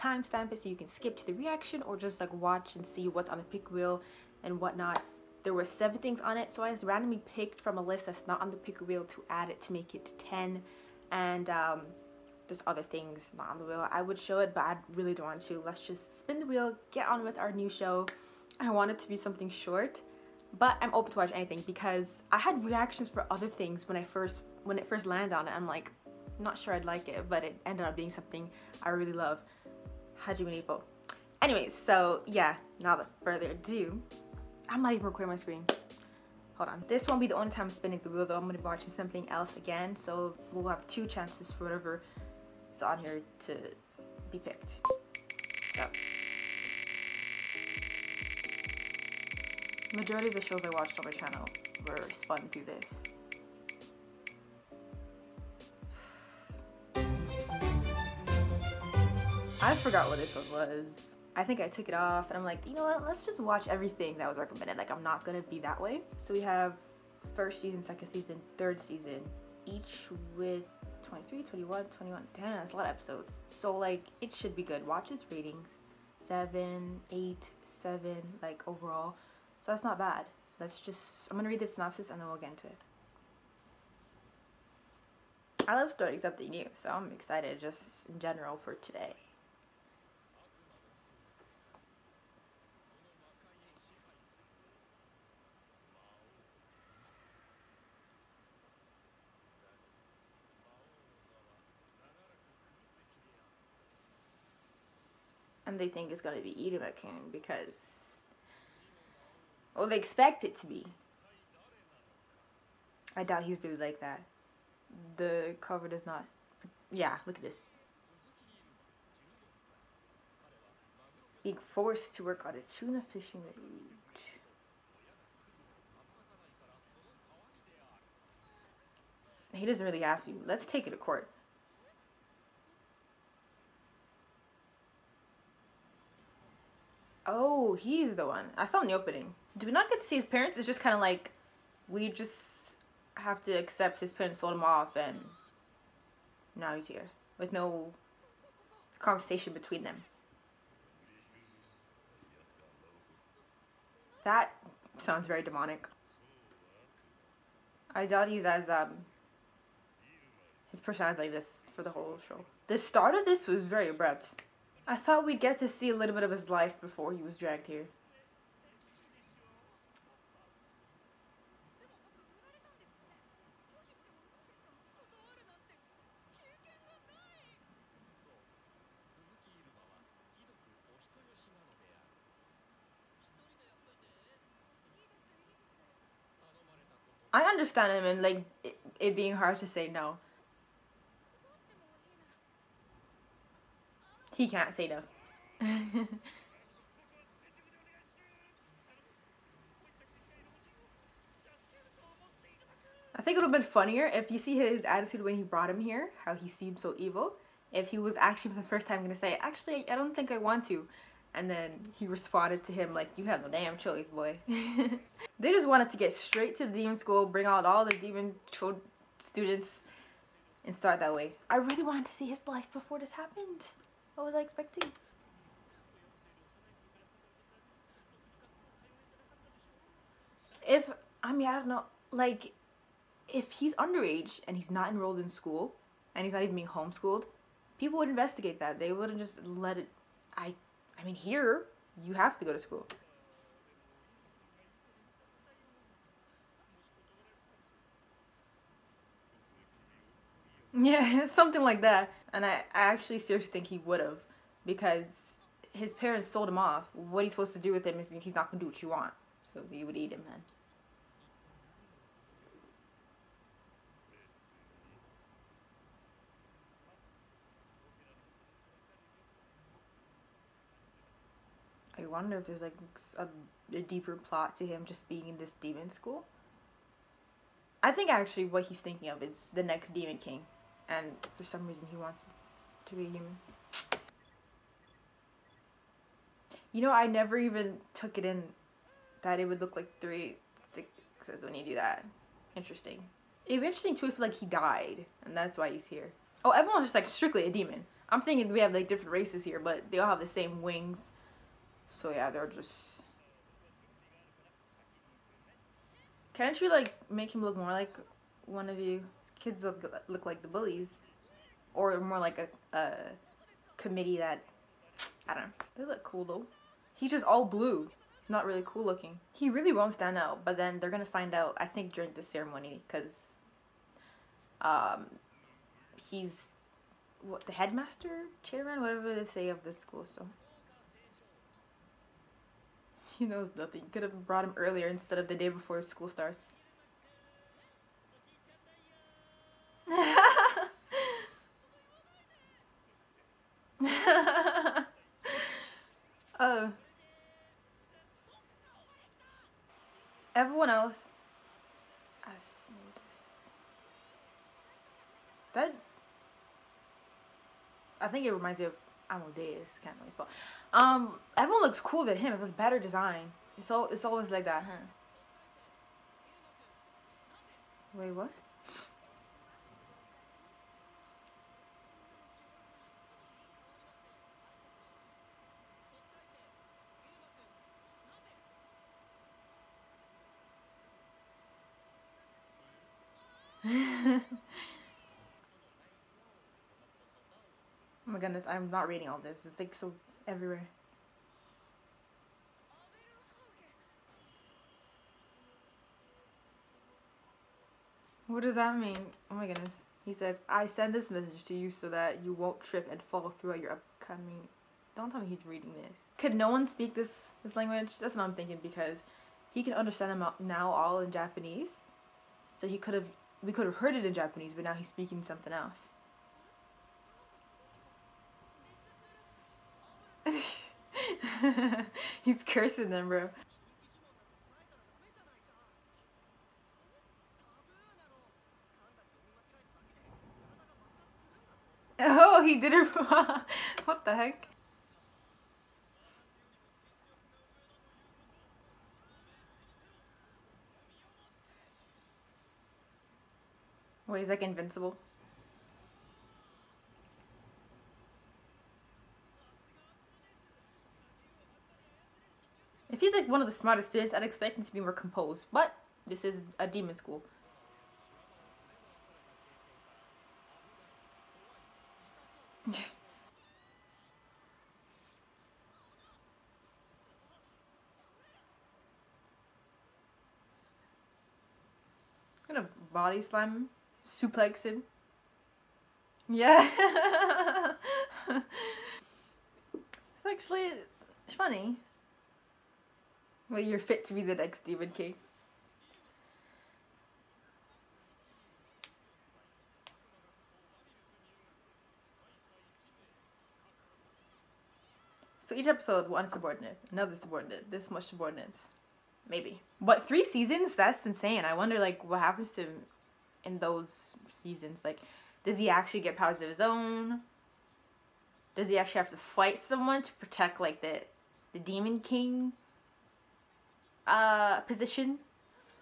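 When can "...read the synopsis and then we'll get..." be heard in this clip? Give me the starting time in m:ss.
1:21.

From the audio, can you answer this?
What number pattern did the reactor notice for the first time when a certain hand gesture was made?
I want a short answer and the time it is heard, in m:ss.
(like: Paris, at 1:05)
Three sixes, at 4:49.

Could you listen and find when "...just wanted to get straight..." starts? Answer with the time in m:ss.
3:35.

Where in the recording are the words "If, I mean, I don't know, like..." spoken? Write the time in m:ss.
3:50.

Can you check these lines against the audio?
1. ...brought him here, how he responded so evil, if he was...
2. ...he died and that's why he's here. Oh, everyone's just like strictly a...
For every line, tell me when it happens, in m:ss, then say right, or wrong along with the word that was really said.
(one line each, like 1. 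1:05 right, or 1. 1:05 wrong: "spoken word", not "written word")
1. 3:25 wrong: "seemed", not "responded"
2. 4:54 right.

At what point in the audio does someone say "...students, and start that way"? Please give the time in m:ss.
3:39.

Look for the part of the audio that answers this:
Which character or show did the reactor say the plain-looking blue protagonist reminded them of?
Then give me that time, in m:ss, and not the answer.
5:59.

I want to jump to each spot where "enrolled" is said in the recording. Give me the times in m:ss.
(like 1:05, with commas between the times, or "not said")
3:54.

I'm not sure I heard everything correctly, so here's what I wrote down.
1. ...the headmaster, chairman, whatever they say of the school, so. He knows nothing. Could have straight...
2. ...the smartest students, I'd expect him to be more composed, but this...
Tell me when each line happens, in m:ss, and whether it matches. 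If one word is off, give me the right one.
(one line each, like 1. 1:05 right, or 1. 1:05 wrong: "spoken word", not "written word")
1. 5:27 wrong: "brought", not "straight"
2. 7:33 right.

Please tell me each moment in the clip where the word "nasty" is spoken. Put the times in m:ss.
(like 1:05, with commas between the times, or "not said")
not said.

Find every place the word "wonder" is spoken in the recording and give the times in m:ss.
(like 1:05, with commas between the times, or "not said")
4:32, 8:21.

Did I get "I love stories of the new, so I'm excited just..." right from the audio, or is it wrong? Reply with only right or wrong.
right.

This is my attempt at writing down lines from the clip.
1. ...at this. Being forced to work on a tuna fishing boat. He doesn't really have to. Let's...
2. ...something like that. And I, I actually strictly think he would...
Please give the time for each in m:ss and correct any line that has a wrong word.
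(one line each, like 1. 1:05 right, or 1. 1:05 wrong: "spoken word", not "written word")
1. 1:57 right
2. 4:11 wrong: "seriously", not "strictly".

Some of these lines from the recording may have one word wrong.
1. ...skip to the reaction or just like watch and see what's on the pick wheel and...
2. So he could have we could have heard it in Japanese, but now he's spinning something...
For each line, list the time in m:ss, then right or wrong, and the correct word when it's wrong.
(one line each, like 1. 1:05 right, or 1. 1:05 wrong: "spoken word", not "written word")
1. 0:00 right
2. 6:52 wrong: "speaking", not "spinning".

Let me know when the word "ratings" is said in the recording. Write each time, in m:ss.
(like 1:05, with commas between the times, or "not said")
1:15.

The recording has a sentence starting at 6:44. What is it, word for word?
Don't tell me he's reading this.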